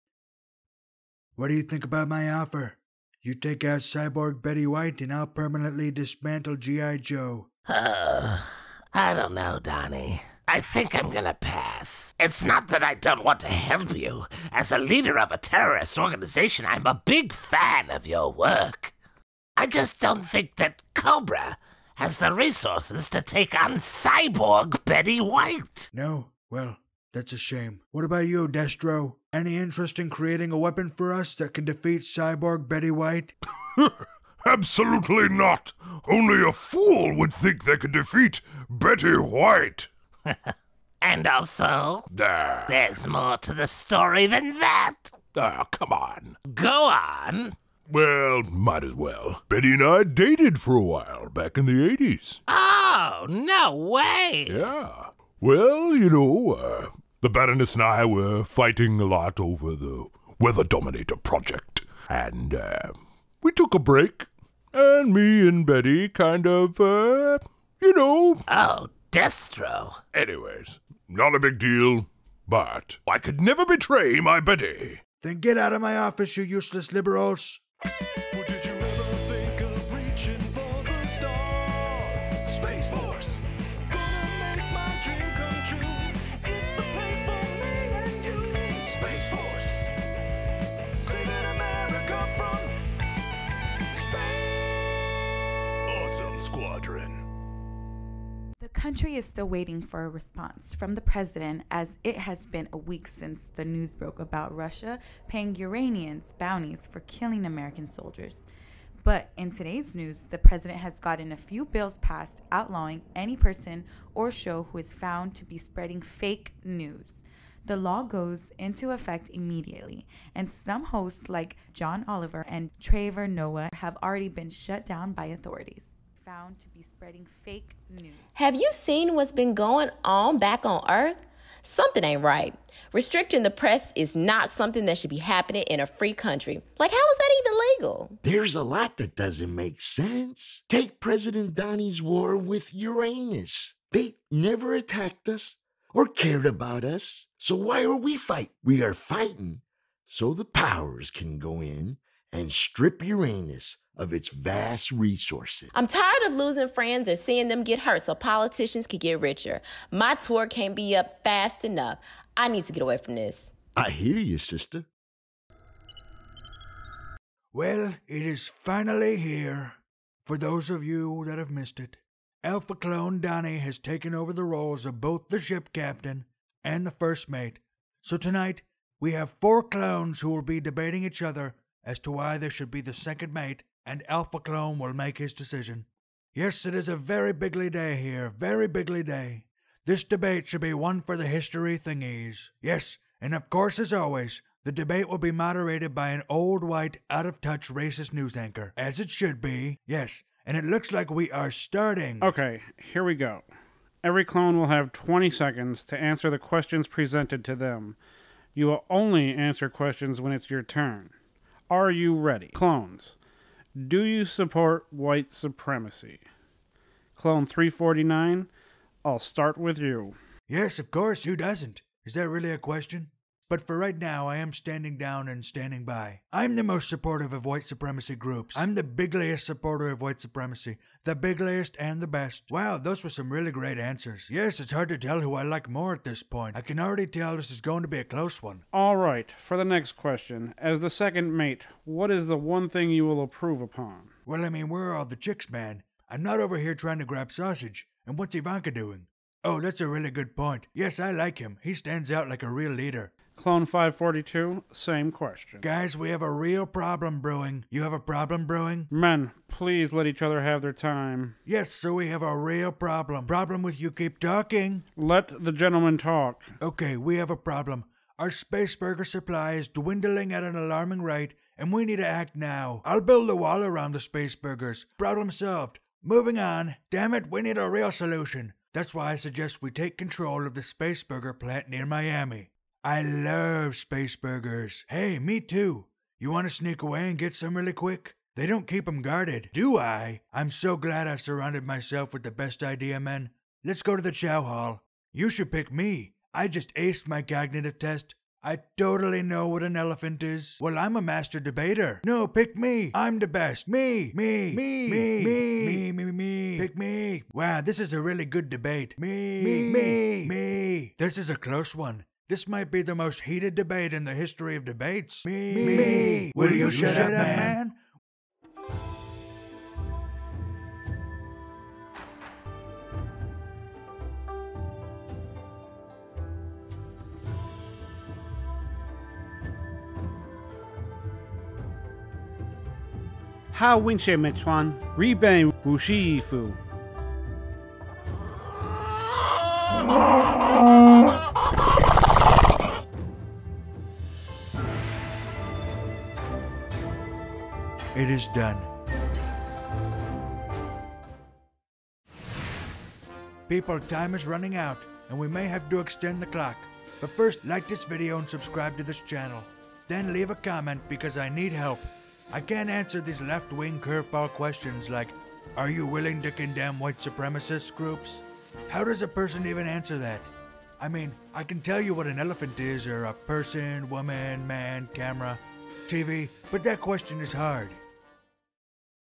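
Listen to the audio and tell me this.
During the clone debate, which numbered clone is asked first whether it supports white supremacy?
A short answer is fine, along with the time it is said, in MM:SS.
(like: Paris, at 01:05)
Clone 349, at 03:37.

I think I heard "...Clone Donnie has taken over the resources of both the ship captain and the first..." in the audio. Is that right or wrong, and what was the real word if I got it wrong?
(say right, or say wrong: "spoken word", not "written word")
wrong: "roles", not "resources".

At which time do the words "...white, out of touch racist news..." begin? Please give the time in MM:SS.
03:16.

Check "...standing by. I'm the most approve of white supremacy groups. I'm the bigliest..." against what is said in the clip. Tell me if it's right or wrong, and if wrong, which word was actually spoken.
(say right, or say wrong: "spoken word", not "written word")
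wrong: "supportive", not "approve".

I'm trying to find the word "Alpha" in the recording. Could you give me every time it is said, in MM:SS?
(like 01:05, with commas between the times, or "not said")
02:52, 03:04.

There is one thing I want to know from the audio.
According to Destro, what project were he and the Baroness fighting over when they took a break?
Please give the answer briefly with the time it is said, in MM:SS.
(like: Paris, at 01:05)
Weather Dominator, at 01:00.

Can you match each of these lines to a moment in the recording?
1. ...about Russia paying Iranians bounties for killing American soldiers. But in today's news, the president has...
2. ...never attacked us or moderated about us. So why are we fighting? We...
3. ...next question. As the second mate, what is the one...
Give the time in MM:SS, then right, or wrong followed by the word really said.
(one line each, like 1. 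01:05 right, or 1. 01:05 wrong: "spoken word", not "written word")
1. 01:44 right
2. 02:24 wrong: "cared", not "moderated"
3. 03:59 right.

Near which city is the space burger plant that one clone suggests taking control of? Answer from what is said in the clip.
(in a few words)
Miami.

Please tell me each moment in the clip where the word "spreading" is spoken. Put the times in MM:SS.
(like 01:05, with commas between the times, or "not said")
01:55, 02:06.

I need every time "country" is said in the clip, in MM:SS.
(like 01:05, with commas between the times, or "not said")
01:38, 02:16.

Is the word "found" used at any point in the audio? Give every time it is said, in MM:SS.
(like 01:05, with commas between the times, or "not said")
01:54, 02:06.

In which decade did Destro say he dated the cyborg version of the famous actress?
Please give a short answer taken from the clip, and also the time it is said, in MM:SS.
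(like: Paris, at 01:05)
the 80s, at 00:51.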